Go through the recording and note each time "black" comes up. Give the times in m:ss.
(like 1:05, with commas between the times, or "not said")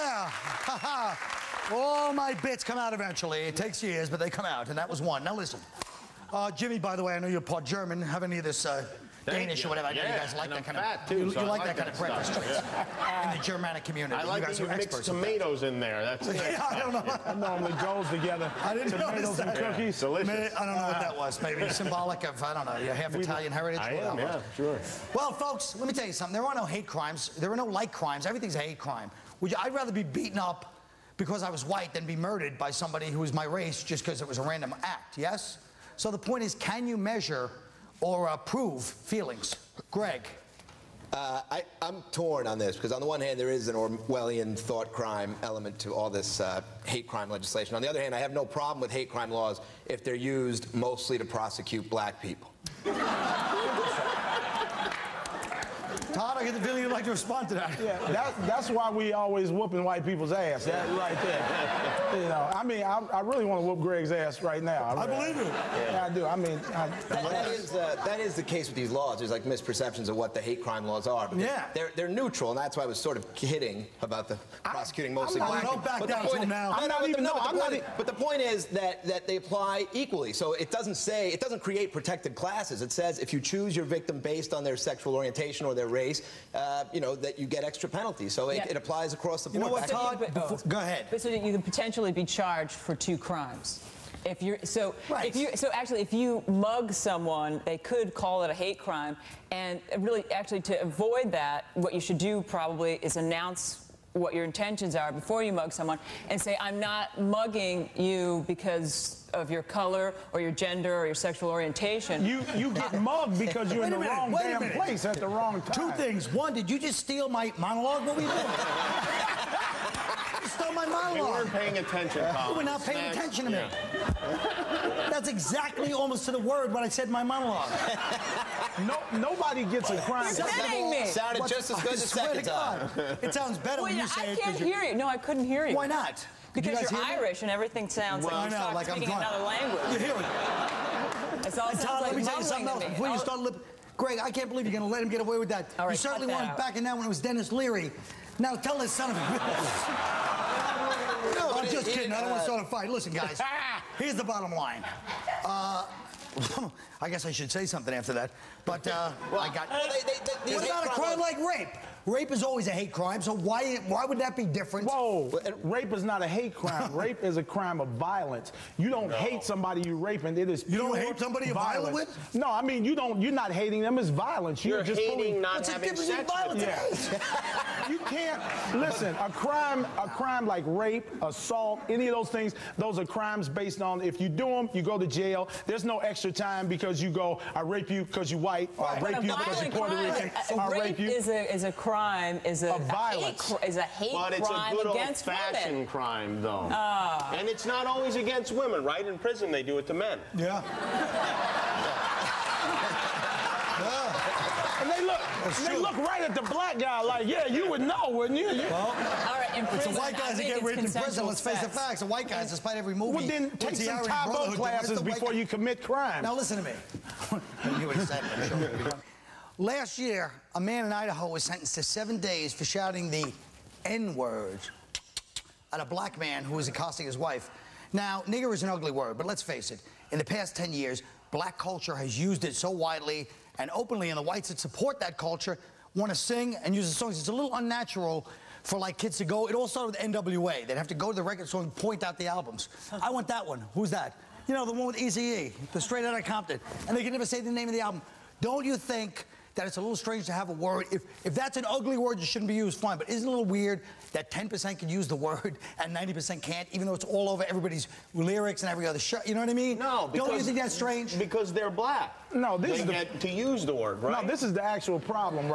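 0:51, 1:15, 3:26, 3:45, 3:51, 4:21.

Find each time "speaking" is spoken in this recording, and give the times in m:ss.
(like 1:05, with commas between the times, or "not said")
2:18.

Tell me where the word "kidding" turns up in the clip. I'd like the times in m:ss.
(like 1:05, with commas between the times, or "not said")
1:13, 2:10, 2:31.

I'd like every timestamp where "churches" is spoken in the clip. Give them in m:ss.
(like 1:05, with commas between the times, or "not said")
not said.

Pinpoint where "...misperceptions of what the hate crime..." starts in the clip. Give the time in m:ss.
1:09.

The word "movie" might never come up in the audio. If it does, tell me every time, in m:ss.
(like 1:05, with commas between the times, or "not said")
3:32.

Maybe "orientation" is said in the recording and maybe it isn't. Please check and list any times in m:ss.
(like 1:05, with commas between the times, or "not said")
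1:25, 1:51.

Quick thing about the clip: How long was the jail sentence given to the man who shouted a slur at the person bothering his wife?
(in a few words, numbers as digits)
7 days.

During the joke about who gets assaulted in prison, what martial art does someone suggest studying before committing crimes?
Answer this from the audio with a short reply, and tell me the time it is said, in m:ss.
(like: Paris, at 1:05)
Taekwondo, at 3:34.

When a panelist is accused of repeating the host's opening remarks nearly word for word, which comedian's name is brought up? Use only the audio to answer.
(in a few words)
Denis Leary.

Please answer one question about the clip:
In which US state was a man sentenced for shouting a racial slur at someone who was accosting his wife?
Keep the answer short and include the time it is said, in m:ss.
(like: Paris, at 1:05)
Idaho, at 3:40.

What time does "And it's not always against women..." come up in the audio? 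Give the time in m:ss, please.
3:17.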